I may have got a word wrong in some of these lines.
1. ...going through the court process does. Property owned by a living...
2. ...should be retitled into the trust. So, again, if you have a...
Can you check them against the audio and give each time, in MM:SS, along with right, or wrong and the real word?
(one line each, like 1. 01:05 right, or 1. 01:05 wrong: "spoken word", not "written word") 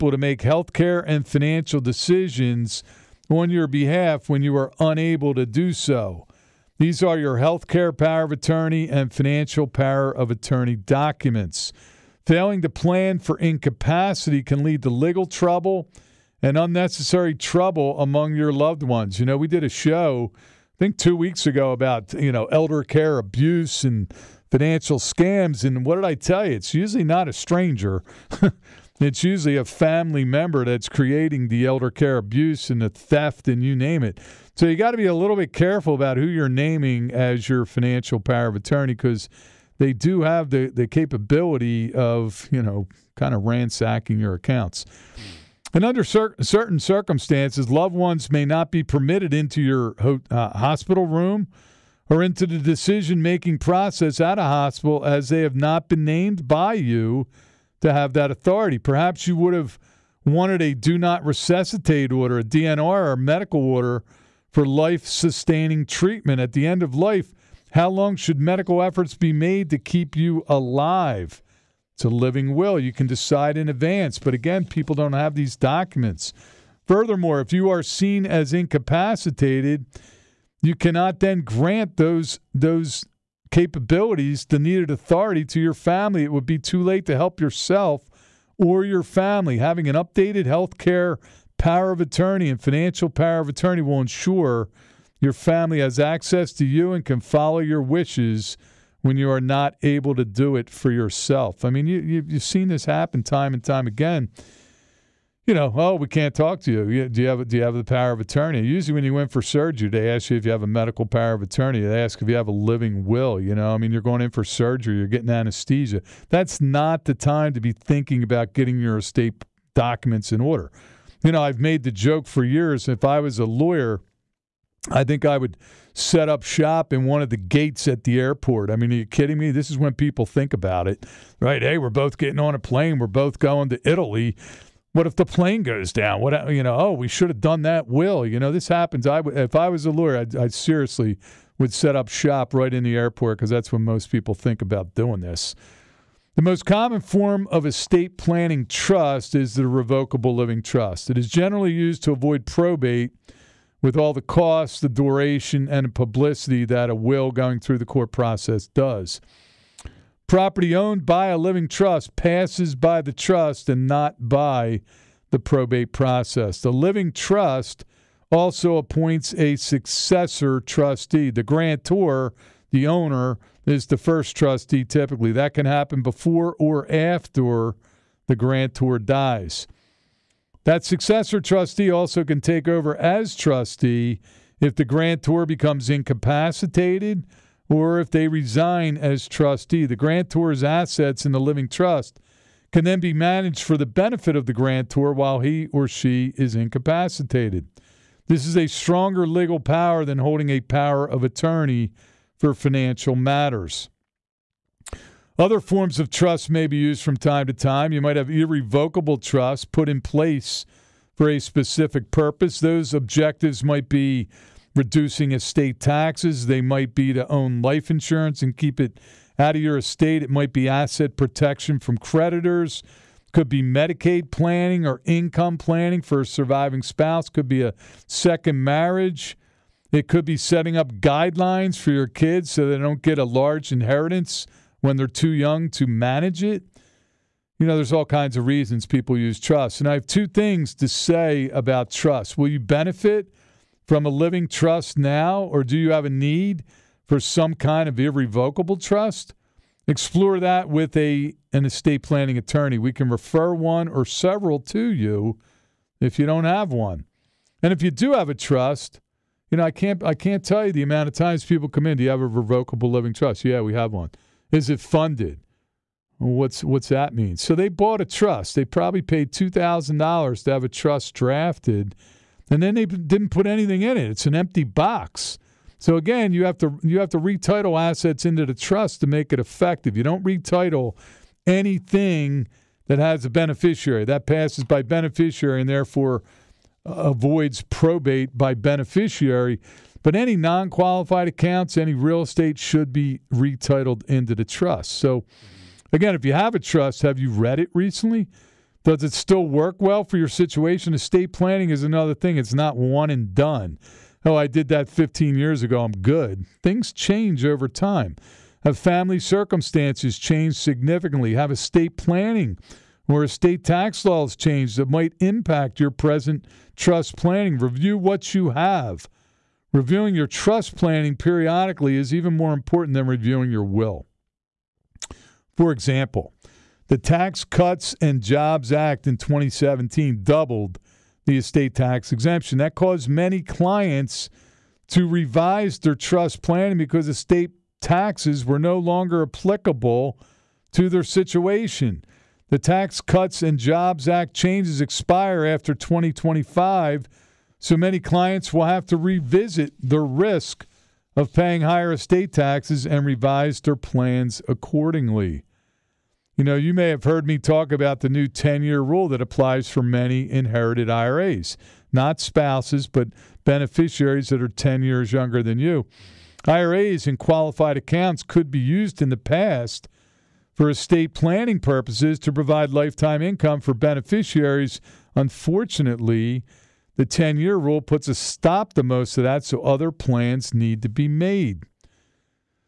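1. 02:37 right
2. 04:52 right.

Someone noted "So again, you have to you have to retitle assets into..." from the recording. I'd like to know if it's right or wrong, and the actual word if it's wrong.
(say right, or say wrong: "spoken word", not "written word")
right.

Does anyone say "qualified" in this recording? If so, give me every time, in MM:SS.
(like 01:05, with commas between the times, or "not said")
04:50, 06:07.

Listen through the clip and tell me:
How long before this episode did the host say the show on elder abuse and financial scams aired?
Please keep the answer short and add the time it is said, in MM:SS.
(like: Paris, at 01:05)
2 weeks ago, at 00:20.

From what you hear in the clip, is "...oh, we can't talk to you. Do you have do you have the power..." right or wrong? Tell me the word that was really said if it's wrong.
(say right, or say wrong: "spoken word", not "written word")
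right.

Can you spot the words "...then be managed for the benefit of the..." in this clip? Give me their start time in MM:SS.
03:12.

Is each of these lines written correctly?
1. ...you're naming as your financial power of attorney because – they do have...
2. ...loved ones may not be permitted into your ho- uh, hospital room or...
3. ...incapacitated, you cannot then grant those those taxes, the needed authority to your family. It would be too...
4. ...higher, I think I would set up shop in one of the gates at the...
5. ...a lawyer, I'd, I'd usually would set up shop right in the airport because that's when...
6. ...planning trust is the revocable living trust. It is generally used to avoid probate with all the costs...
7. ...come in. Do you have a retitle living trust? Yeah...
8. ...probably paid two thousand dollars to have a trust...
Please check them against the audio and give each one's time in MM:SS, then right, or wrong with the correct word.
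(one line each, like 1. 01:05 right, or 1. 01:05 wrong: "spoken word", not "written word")
1. 00:36 right
2. 00:47 right
3. 01:18 wrong: "capabilities", not "taxes"
4. 02:03 wrong: "lawyer", not "higher"
5. 02:19 wrong: "seriously", not "usually"
6. 02:28 right
7. 04:21 wrong: "revocable", not "retitle"
8. 04:28 right.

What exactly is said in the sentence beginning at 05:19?
Reviewing your trust planning periodically is even more important than reviewing your will.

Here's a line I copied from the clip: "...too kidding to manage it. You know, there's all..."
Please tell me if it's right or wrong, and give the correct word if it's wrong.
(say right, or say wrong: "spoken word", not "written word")
wrong: "young", not "kidding".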